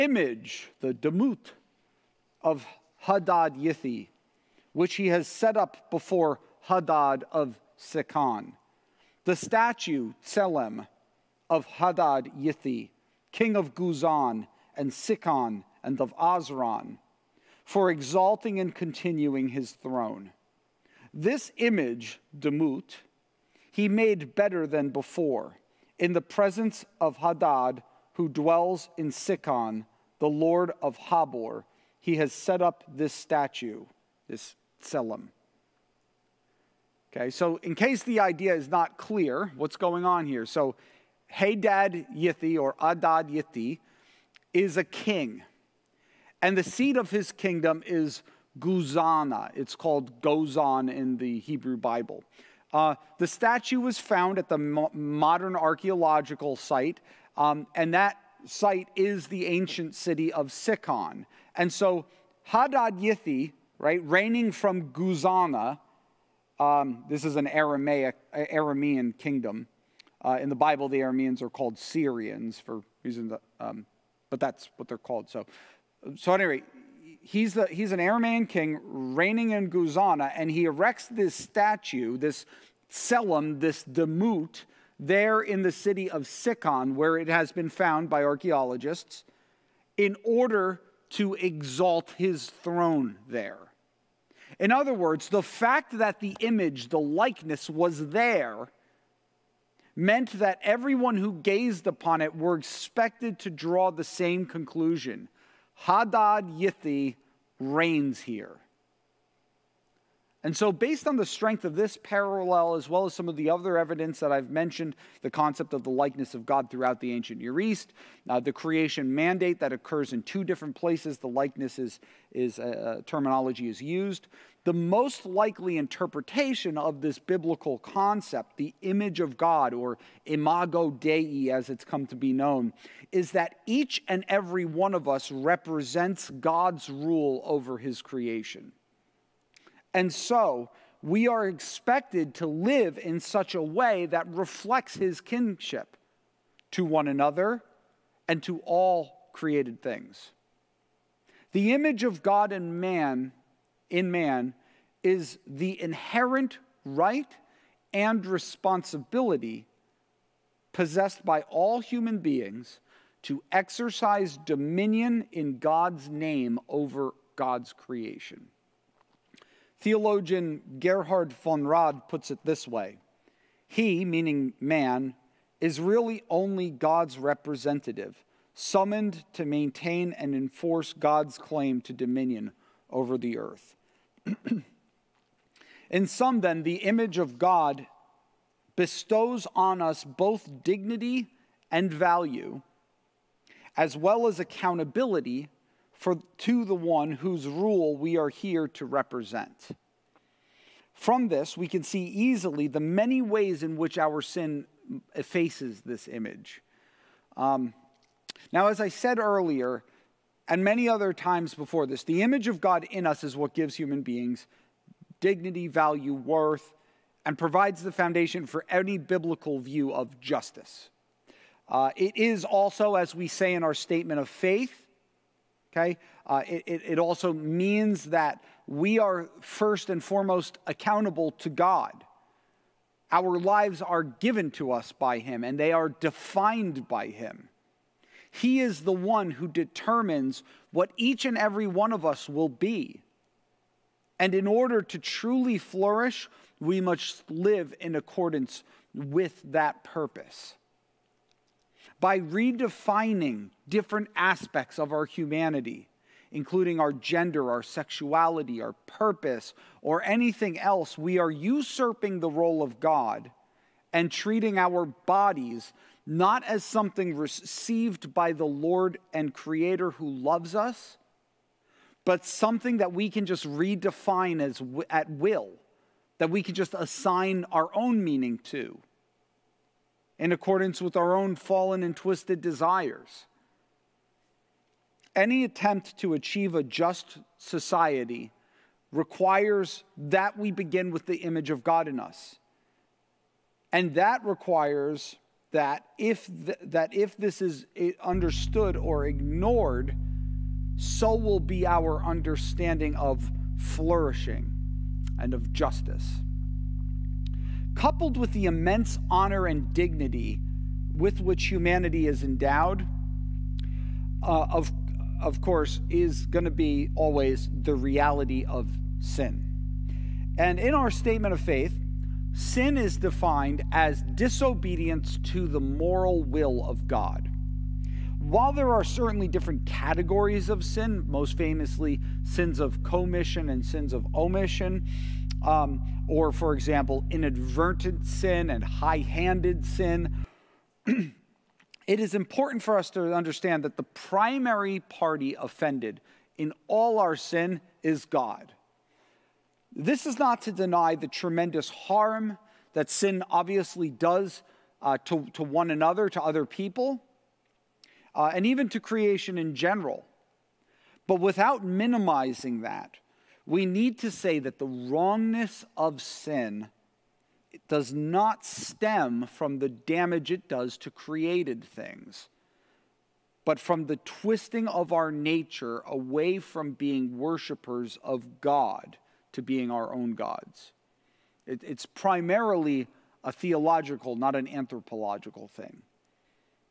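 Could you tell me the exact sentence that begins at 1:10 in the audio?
Uh, in the Bible, the Arameans are called Syrians for reasons, that, um, but that's what they're called.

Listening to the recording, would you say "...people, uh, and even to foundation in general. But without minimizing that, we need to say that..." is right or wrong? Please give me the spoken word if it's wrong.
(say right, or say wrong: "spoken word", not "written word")
wrong: "creation", not "foundation".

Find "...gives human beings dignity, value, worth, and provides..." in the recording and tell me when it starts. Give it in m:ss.
3:33.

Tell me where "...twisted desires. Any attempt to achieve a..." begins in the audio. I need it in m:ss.
4:41.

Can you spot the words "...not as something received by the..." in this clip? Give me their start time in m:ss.
4:26.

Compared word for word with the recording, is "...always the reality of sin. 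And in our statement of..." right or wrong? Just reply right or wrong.
right.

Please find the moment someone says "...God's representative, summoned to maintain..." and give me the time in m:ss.
2:56.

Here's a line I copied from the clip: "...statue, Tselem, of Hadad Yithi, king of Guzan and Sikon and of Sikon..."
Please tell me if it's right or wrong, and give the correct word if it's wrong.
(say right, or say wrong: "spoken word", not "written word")
wrong: "Azran", not "Sikon".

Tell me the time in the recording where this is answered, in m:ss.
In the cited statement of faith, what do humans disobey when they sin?
5:25.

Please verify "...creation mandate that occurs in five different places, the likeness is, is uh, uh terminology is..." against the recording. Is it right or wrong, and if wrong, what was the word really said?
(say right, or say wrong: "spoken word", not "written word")
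wrong: "two", not "five".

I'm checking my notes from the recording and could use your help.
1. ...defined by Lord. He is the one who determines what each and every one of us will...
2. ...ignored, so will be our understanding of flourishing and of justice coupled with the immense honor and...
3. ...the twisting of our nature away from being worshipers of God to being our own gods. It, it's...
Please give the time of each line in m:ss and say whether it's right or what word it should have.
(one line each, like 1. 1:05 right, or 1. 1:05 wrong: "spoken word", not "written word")
1. 3:55 wrong: "Him", not "Lord"
2. 4:59 right
3. 6:13 right.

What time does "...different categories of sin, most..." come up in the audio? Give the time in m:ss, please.
5:29.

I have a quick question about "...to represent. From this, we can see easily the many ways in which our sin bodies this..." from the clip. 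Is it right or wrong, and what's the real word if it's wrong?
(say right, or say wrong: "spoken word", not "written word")
wrong: "effaces", not "bodies".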